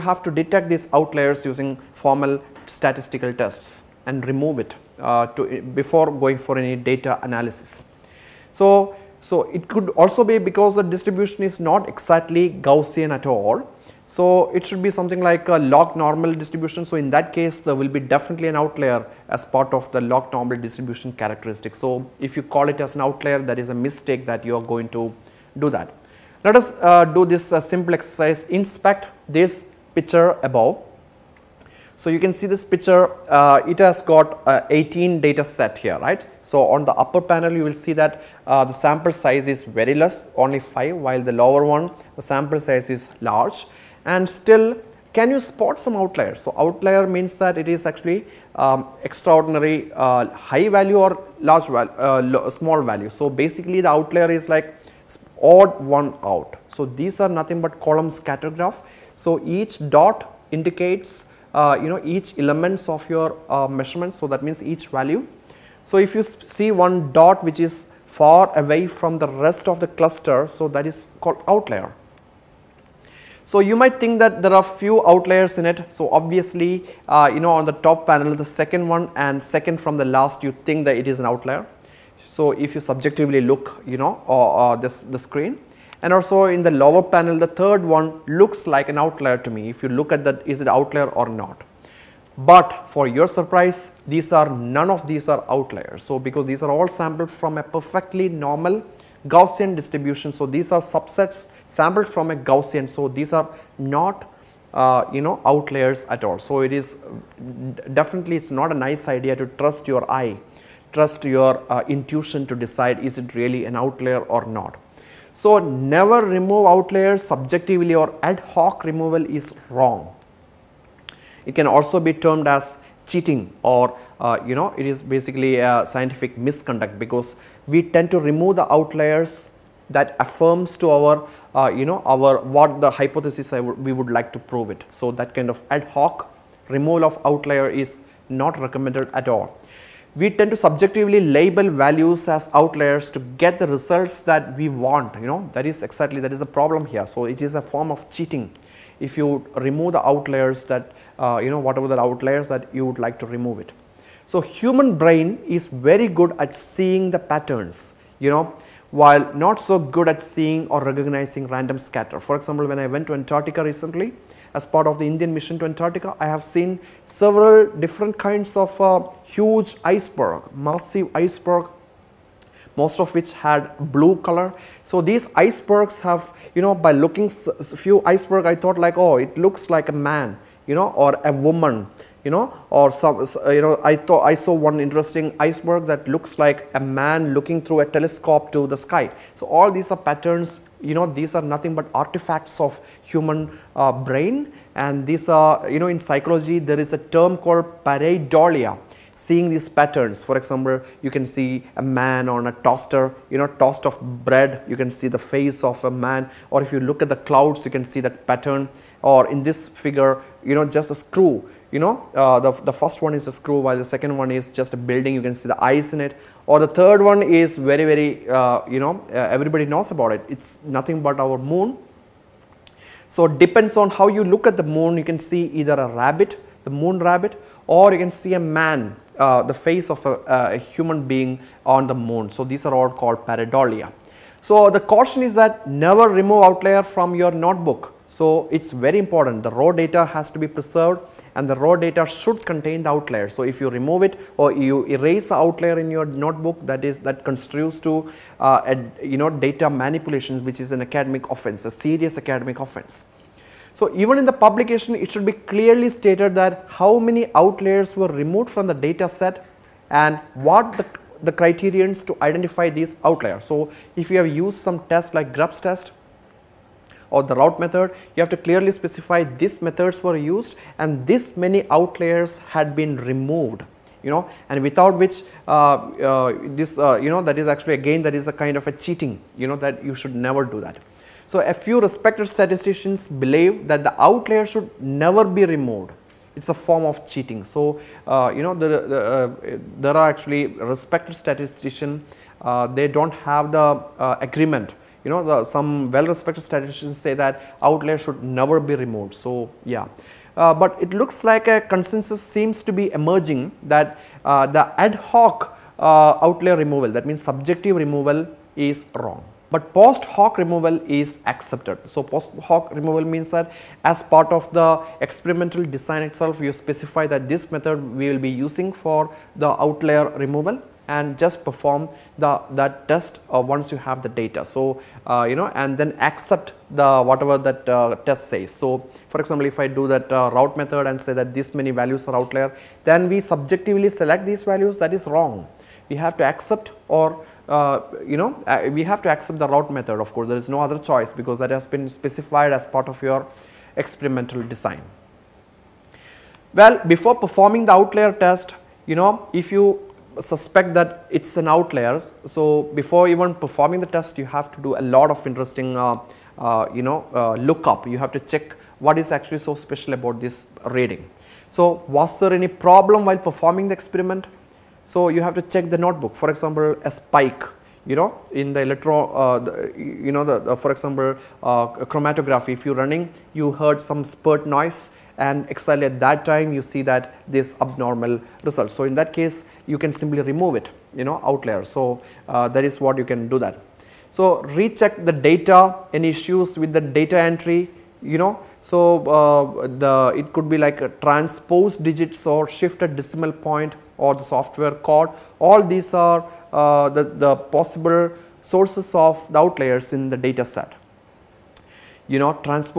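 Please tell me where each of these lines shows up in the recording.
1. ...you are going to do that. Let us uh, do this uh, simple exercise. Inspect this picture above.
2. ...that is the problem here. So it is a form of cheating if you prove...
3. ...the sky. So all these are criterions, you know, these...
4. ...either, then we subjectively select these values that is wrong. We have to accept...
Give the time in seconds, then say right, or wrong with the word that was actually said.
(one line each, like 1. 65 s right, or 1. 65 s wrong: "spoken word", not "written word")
1. 24 s right
2. 146 s wrong: "remove", not "prove"
3. 188 s wrong: "patterns", not "criterions"
4. 332 s wrong: "outlier", not "either".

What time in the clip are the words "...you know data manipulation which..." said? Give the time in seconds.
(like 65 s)
249 s.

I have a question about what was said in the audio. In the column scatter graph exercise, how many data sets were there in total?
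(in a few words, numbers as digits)
18.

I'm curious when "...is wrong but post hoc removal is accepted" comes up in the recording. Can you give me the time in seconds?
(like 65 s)
308 s.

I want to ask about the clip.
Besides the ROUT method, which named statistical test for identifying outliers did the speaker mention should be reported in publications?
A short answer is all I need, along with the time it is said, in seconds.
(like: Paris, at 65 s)
Grubbs test, at 265 s.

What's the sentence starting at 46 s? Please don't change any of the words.
So outlier means that it is actually um, extraordinary uh, high value or large value, uh, small value.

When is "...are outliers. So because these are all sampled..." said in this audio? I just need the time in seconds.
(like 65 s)
95 s.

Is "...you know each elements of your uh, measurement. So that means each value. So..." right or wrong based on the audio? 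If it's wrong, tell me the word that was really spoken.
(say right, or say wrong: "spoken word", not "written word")
right.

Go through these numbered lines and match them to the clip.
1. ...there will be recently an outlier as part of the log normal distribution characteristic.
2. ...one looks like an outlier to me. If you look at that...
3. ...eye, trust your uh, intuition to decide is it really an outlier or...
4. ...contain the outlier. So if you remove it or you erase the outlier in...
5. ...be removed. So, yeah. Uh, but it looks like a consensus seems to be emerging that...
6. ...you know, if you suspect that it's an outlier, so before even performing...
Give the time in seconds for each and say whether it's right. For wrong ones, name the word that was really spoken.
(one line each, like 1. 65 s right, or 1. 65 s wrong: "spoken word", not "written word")
1. 17 s wrong: "definitely", not "recently"
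2. 87 s right
3. 110 s right
4. 242 s right
5. 298 s right
6. 348 s right.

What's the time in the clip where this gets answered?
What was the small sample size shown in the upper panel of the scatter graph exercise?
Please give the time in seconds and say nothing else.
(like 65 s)
40 s.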